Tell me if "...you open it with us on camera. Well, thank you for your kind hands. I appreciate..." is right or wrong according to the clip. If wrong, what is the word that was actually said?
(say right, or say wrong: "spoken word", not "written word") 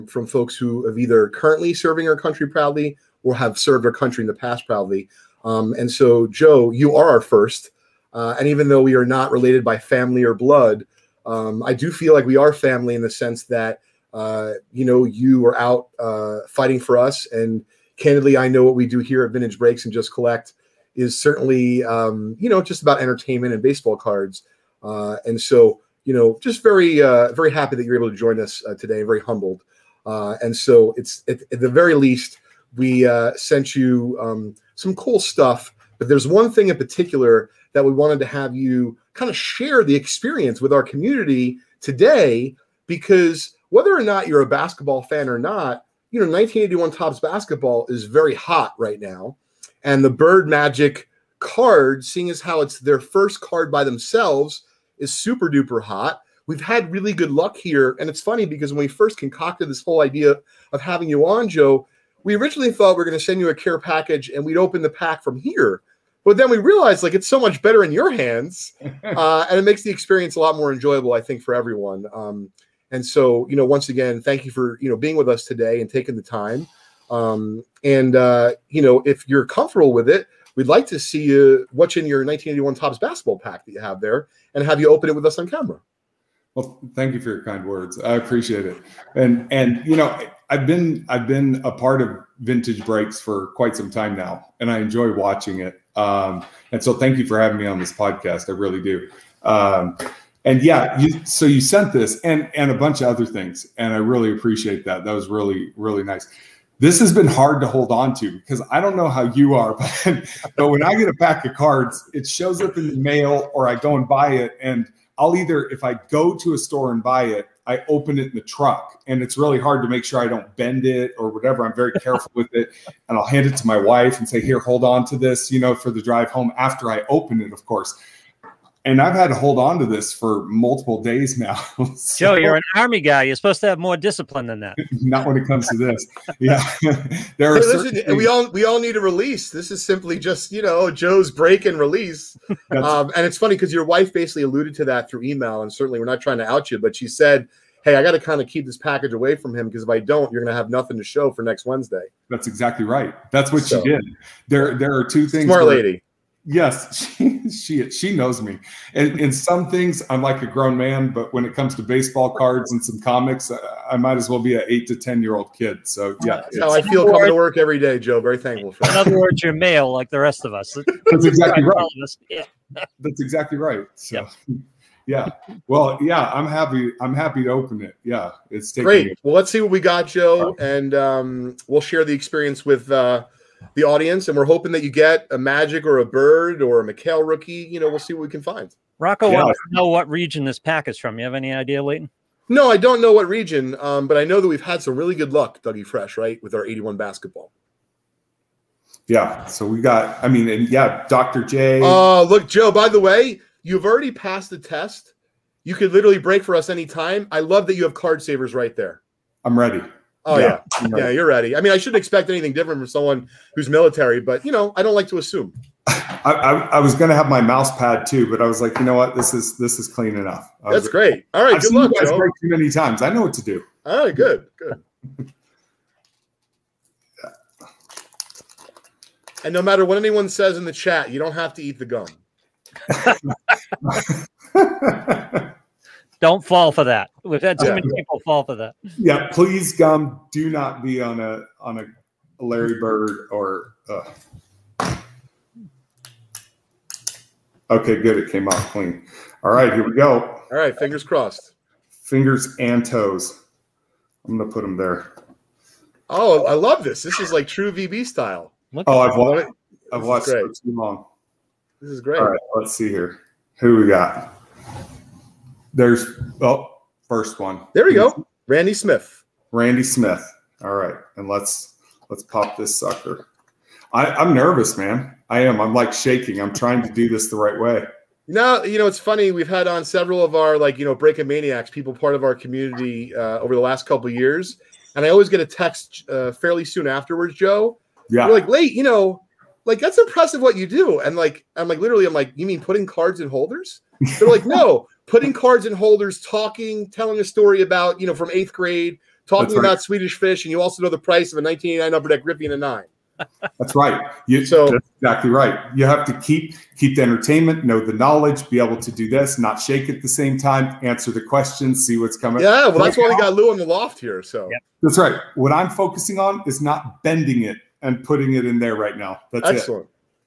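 wrong: "words", not "hands".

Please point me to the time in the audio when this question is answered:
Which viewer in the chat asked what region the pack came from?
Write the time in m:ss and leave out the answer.
3:08.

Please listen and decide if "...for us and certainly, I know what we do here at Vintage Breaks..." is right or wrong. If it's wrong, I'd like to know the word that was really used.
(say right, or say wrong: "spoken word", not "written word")
wrong: "candidly", not "certainly".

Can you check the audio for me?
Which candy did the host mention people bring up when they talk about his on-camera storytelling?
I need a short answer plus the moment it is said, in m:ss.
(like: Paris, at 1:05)
Swedish fish, at 4:59.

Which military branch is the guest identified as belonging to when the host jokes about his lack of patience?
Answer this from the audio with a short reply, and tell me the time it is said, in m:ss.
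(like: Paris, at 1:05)
Army, at 2:12.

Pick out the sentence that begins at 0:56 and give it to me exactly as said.
We've had really good luck here.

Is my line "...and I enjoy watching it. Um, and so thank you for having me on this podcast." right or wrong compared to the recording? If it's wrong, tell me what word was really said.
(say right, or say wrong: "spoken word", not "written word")
right.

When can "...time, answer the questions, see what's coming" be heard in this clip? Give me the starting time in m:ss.
5:10.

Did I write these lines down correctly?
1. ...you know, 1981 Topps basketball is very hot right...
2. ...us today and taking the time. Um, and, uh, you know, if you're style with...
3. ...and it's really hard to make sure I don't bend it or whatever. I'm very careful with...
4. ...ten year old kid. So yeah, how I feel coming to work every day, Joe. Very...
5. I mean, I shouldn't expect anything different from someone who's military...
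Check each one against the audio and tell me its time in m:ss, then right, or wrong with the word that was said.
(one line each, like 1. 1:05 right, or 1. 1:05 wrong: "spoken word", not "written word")
1. 0:46 right
2. 1:15 wrong: "comfortable", not "style"
3. 1:59 right
4. 2:44 right
5. 3:31 right.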